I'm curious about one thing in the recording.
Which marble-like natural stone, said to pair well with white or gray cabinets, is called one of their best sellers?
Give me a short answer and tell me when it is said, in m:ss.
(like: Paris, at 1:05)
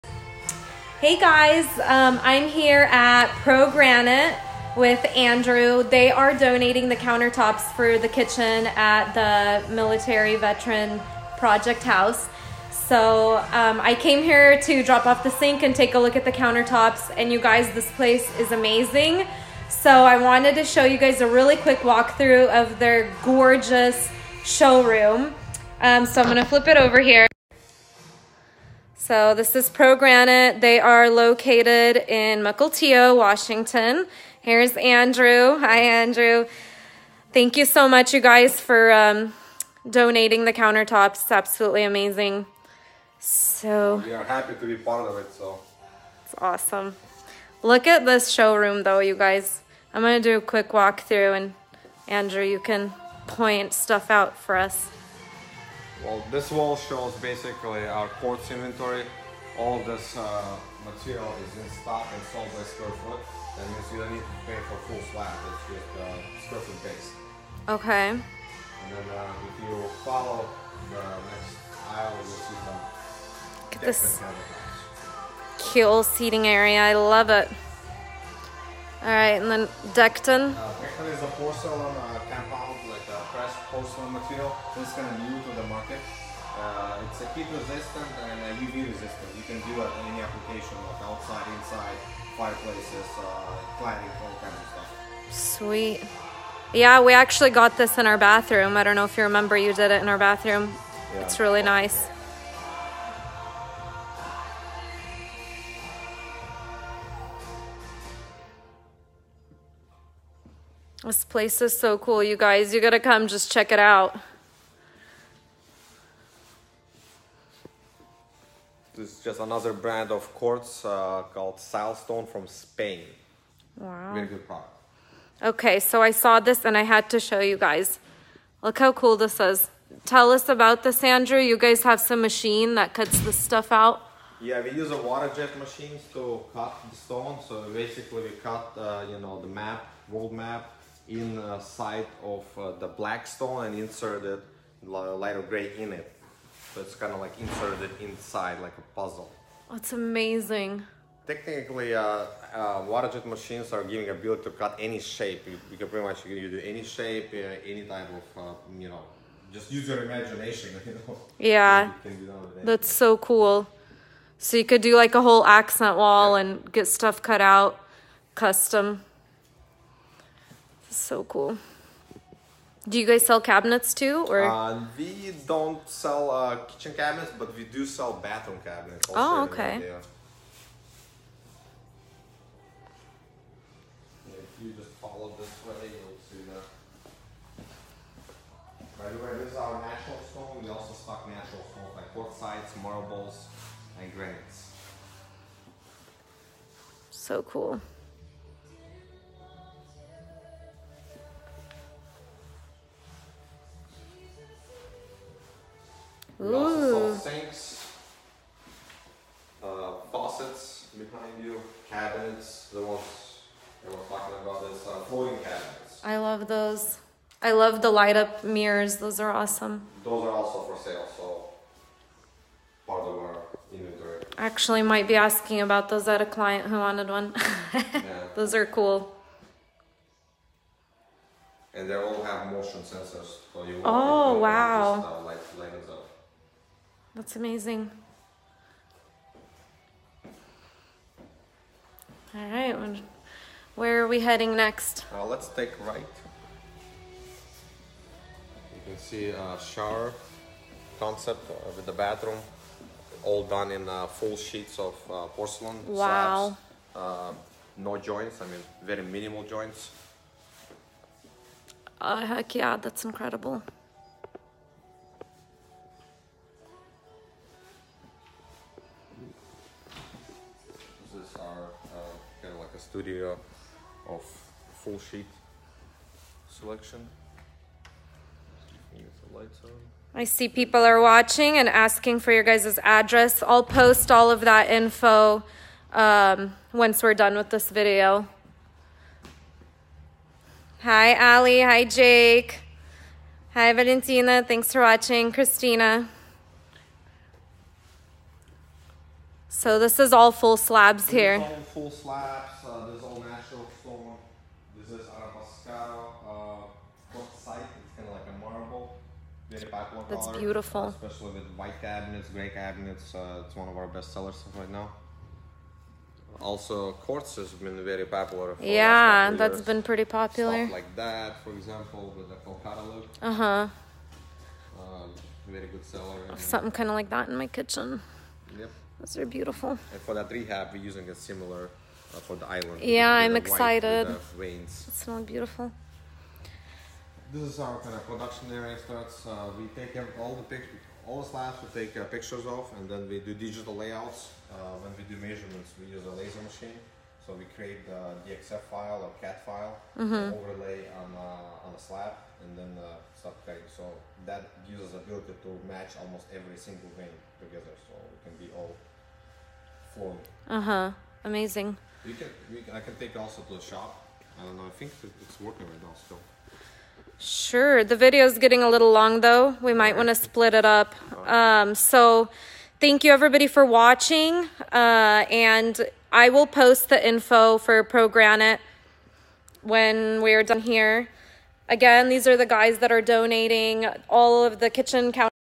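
Arabescato, at 5:05.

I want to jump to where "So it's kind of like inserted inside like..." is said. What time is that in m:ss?
2:26.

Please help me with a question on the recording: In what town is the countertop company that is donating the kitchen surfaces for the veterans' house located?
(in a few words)
Mukilteo, Washington.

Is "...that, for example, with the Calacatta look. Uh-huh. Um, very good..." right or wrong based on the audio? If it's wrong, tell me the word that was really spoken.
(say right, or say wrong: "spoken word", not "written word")
right.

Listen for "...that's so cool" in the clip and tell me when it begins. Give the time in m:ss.
2:42.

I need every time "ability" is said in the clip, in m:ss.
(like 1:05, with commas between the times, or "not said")
2:34, 5:55.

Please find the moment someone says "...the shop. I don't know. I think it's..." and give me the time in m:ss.
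6:03.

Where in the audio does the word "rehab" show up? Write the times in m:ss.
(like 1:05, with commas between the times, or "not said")
5:30.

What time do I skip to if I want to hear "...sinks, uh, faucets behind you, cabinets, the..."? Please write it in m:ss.
3:27.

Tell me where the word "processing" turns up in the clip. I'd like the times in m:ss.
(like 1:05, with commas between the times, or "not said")
not said.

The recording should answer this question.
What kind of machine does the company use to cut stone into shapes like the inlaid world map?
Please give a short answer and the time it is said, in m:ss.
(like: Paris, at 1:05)
Water jet machine, at 2:15.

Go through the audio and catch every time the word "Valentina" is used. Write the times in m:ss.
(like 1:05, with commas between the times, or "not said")
4:53.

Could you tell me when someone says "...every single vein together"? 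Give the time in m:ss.
5:56.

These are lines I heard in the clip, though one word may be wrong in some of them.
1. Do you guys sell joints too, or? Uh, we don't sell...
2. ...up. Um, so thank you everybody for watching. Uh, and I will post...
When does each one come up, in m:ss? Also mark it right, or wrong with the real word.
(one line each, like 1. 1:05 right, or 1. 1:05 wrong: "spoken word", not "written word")
1. 2:52 wrong: "cabinets", not "joints"
2. 6:10 right.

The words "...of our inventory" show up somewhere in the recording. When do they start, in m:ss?
3:43.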